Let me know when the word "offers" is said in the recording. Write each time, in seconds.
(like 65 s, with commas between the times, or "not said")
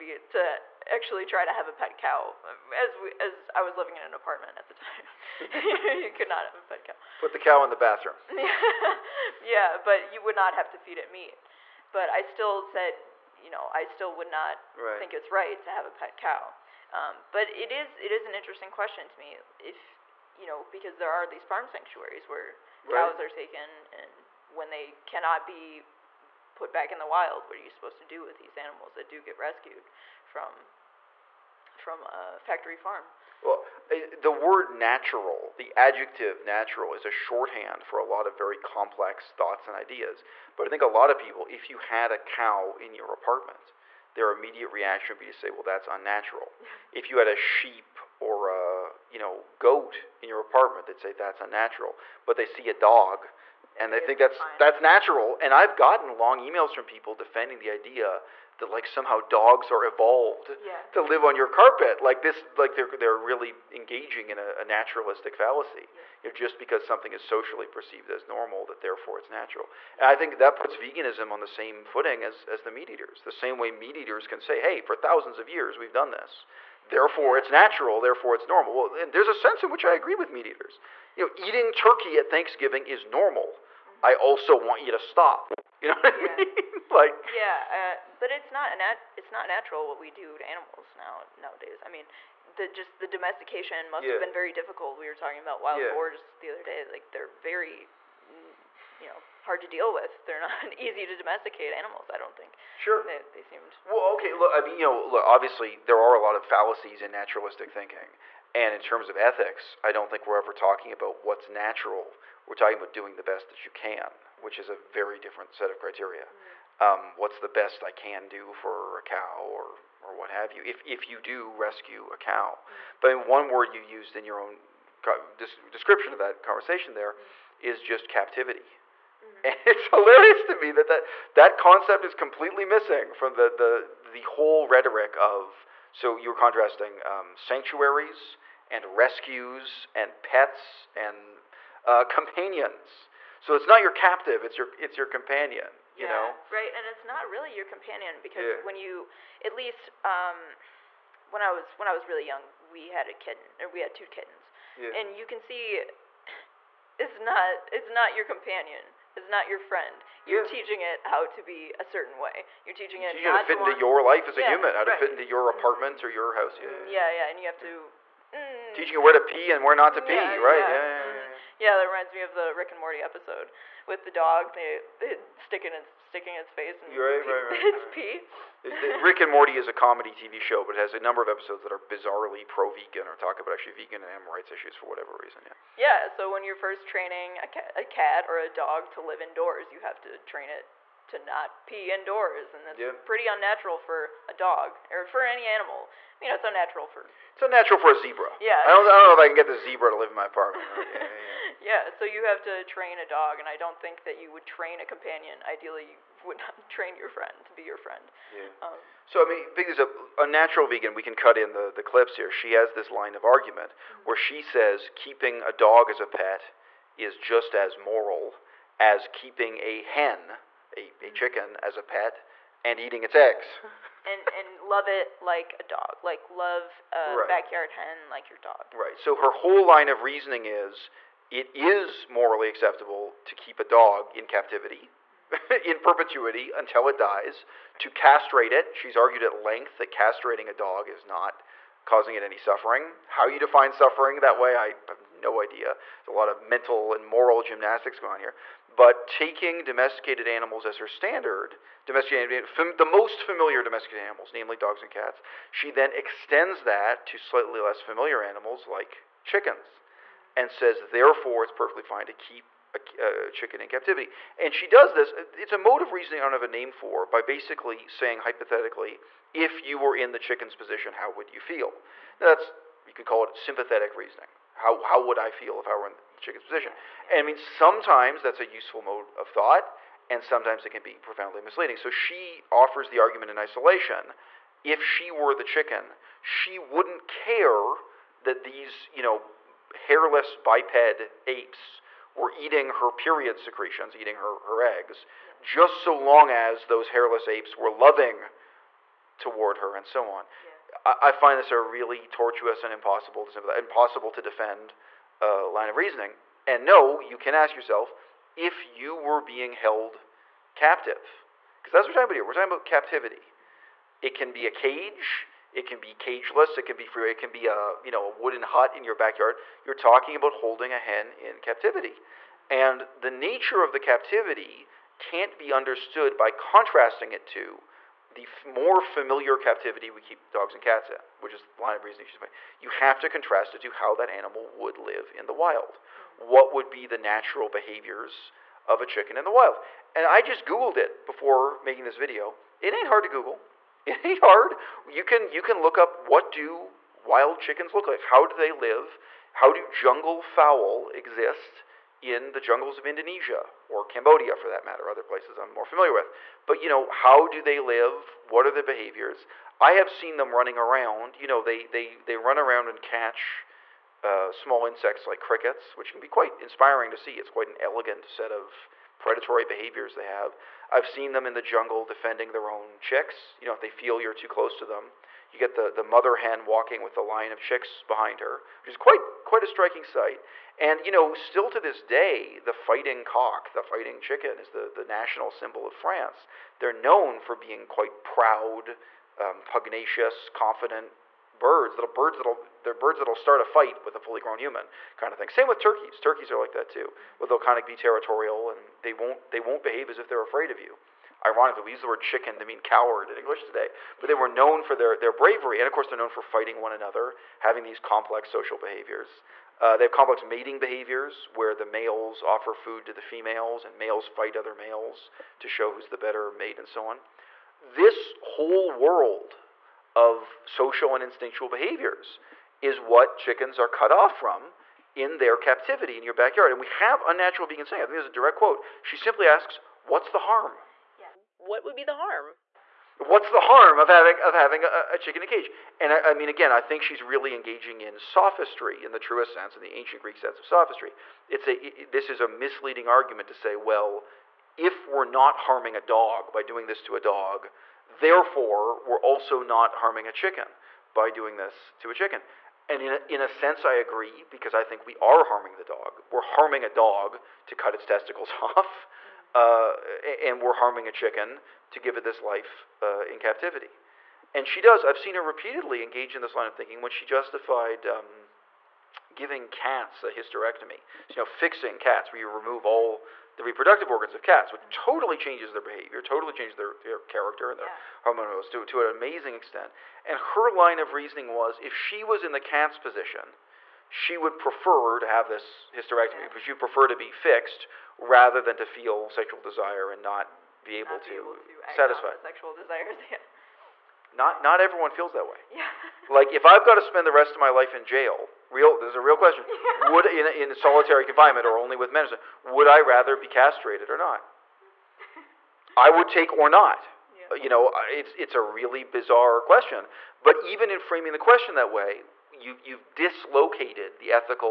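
282 s, 412 s.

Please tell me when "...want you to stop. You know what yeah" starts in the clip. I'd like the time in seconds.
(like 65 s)
84 s.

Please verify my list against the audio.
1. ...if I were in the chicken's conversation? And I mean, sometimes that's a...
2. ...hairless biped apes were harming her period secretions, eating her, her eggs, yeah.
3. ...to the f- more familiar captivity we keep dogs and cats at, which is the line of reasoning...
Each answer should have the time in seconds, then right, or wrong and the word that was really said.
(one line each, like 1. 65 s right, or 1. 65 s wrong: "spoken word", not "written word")
1. 275 s wrong: "position", not "conversation"
2. 289 s wrong: "eating", not "harming"
3. 327 s right.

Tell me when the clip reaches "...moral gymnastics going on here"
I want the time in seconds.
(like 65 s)
247 s.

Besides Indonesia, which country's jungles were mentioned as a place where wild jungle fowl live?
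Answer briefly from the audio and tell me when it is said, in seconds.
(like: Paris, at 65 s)
Cambodia, at 353 s.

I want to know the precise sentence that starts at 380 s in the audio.
And you know, still to this day, the fighting cock, the fighting chicken, is the, the national symbol of France.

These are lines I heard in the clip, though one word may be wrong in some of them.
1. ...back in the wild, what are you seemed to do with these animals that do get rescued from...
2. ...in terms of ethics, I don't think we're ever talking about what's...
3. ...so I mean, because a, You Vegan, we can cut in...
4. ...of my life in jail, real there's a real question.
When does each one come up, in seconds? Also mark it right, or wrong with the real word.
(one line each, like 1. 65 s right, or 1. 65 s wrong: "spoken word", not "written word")
1. 26 s wrong: "supposed", not "seemed"
2. 108 s right
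3. 209 s wrong: "Unnatural", not "You"
4. 497 s right.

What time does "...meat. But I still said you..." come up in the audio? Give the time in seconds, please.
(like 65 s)
11 s.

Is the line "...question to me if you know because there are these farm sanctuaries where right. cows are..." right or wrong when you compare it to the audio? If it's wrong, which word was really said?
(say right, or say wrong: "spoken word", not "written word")
right.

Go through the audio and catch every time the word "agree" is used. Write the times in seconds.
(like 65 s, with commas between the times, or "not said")
79 s, 453 s.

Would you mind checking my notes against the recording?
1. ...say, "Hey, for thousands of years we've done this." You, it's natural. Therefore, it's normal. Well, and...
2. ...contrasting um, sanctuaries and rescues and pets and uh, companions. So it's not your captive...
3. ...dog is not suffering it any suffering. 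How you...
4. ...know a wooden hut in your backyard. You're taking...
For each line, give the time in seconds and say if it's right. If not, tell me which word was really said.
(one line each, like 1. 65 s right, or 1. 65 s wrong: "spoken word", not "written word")
1. 74 s wrong: "Therefore", not "You"
2. 136 s right
3. 240 s wrong: "causing", not "suffering"
4. 317 s wrong: "talking", not "taking".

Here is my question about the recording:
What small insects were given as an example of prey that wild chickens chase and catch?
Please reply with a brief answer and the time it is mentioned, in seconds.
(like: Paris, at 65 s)
crickets, at 365 s.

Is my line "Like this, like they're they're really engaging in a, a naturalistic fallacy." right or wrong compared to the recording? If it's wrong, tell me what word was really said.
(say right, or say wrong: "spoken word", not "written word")
right.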